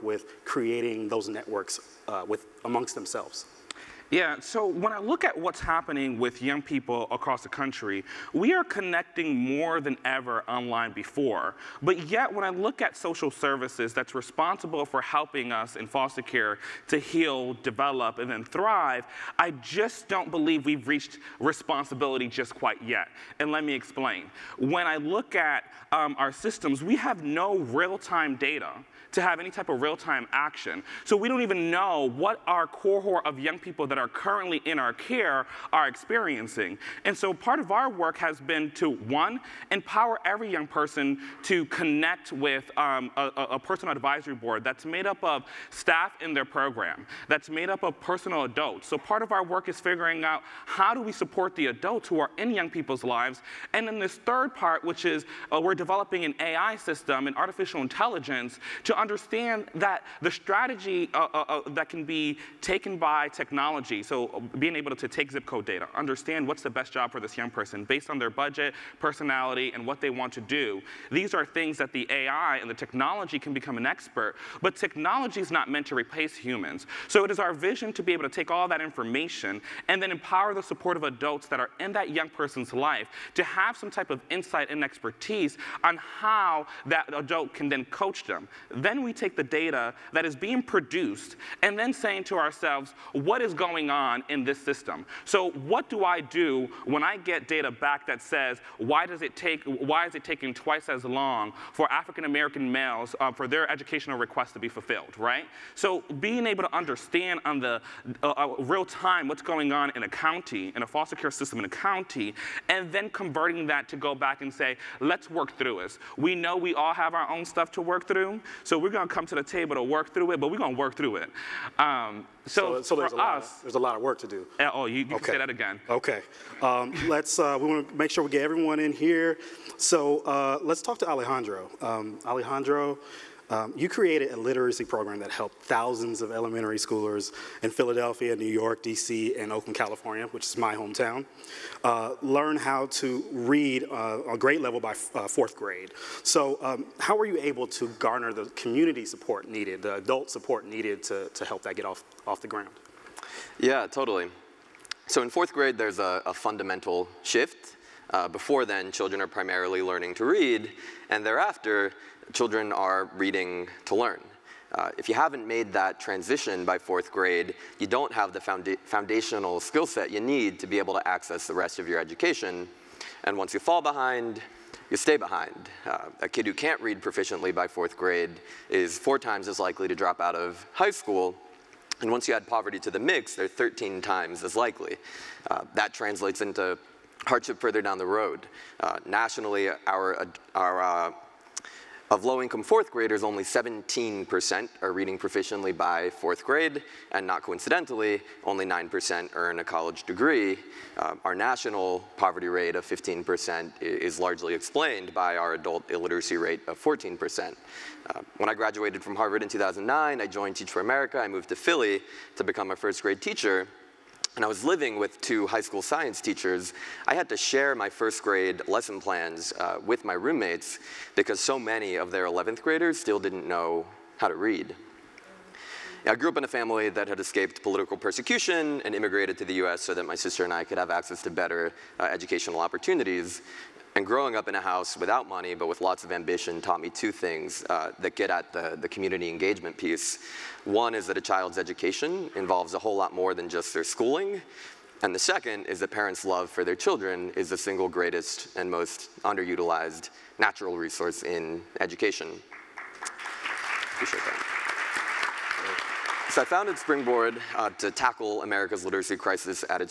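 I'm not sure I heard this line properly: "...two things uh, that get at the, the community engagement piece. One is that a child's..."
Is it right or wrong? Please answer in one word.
right.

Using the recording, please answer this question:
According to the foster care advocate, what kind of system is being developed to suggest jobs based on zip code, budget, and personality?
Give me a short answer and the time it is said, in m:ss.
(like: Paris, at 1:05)
AI system, at 0:56.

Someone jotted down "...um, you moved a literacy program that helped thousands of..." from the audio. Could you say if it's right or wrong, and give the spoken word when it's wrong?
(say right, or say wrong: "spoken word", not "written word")
wrong: "created", not "moved".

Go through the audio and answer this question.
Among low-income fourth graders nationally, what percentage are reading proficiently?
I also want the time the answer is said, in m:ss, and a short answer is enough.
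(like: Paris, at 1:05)
17%, at 3:13.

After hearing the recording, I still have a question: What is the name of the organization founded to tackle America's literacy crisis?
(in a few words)
Springboard.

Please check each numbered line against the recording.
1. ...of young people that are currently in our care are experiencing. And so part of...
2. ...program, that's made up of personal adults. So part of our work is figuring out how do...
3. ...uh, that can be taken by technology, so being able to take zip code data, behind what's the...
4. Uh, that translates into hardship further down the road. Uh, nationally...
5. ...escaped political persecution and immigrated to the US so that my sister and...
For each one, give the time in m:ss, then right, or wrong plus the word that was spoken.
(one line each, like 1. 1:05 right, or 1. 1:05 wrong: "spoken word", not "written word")
1. 0:33 right
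2. 0:46 right
3. 1:01 wrong: "understand", not "behind"
4. 3:05 right
5. 3:47 right.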